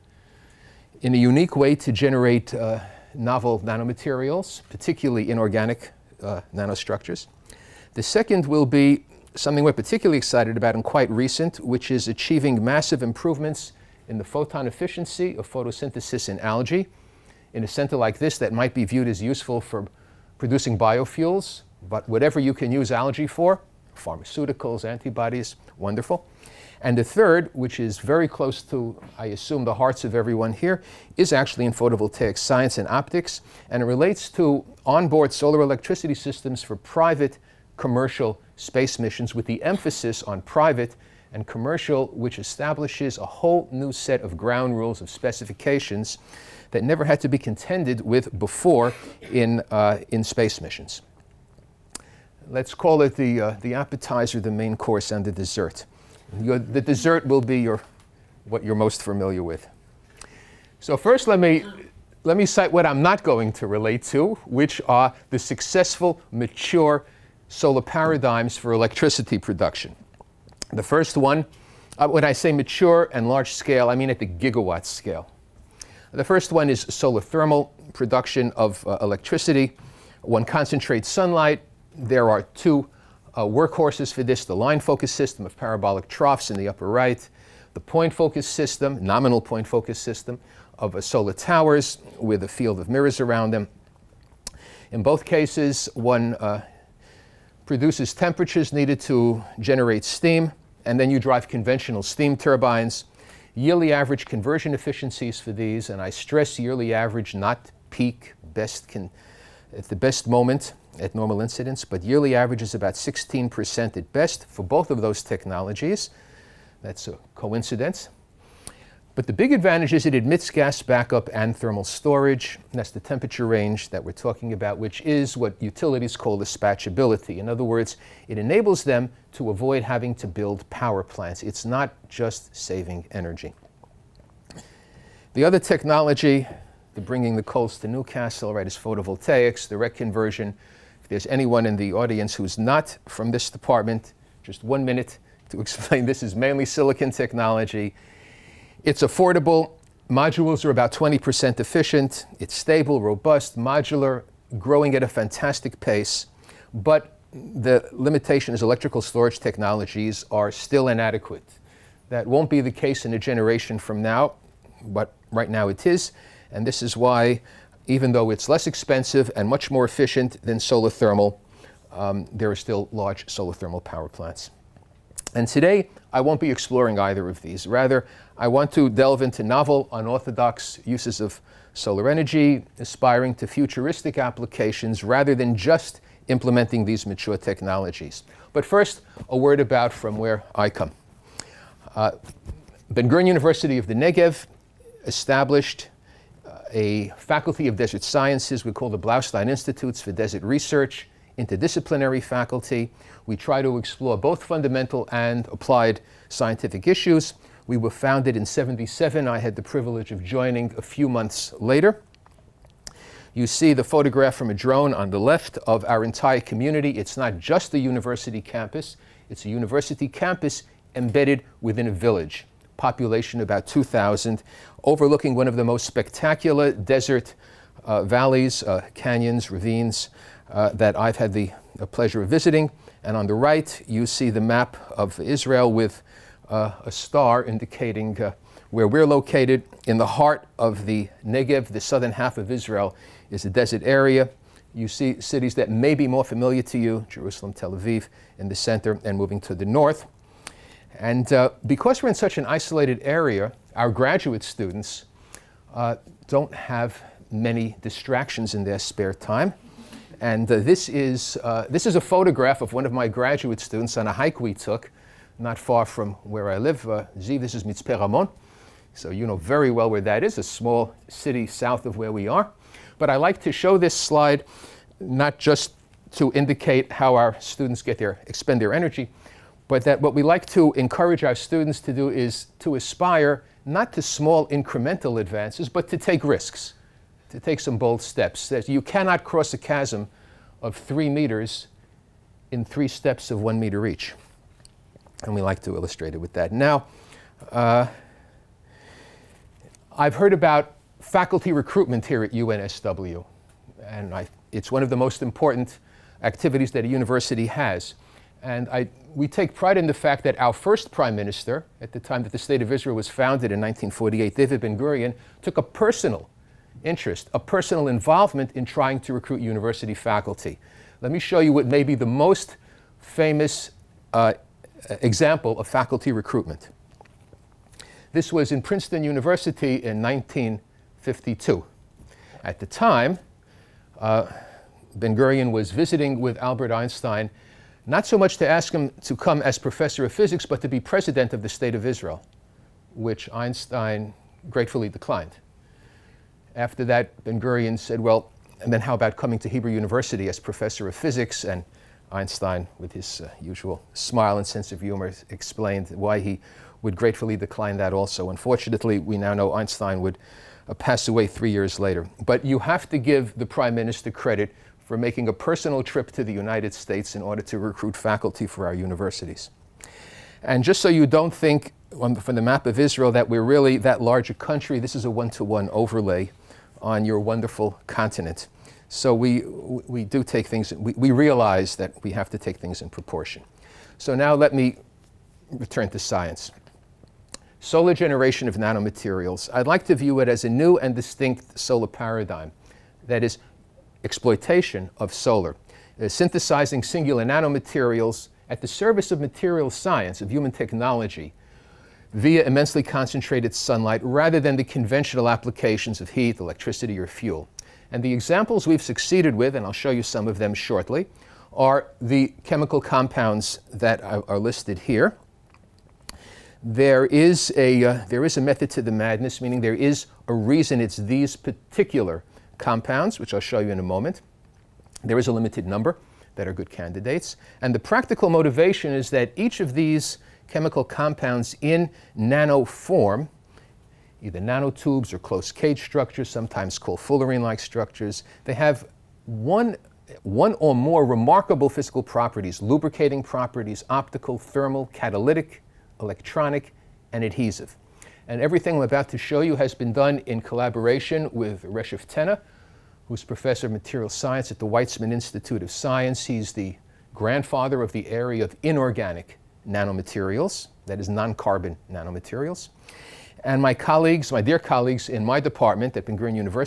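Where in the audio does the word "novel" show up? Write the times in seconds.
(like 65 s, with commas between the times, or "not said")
3 s, 179 s.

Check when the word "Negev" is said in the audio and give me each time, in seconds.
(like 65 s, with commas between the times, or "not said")
193 s, 241 s.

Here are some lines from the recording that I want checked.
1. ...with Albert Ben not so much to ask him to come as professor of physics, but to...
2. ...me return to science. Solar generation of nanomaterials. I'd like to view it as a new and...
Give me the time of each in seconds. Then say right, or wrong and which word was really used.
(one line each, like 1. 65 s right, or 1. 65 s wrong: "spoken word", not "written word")
1. 336 s wrong: "Einstein", not "Ben"
2. 384 s right.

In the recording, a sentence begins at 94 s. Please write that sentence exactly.
In both cases, one uh, produces temperatures needed to generate steam, and then you drive conventional steam turbines.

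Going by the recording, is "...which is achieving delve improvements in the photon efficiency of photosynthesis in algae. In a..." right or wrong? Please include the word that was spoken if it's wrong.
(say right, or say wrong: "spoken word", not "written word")
wrong: "massive", not "delve".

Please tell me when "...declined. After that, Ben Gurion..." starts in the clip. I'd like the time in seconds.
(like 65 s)
344 s.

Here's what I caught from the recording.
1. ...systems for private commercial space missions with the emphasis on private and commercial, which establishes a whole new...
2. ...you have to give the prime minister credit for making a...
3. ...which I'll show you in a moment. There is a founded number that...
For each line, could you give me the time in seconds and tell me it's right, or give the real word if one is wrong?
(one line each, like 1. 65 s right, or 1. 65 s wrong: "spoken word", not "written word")
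1. 36 s right
2. 362 s right
3. 423 s wrong: "limited", not "founded".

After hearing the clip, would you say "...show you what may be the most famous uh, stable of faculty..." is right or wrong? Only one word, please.
wrong.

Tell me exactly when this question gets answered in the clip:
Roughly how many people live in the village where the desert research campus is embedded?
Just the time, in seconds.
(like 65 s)
223 s.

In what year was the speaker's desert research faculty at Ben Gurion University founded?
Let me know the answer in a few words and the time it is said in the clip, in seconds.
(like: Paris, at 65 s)
1977, at 208 s.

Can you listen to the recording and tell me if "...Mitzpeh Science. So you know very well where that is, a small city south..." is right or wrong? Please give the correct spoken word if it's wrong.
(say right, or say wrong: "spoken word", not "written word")
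wrong: "Ramon", not "Science".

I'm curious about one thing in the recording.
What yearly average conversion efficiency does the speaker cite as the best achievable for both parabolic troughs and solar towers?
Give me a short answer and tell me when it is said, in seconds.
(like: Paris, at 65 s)
16%, at 112 s.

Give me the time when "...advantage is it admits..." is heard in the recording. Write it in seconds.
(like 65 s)
119 s.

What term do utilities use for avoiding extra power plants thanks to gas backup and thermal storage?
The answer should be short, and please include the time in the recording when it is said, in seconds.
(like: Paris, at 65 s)
dispatchability, at 126 s.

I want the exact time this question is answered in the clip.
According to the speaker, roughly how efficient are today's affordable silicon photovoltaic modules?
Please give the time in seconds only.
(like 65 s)
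150 s.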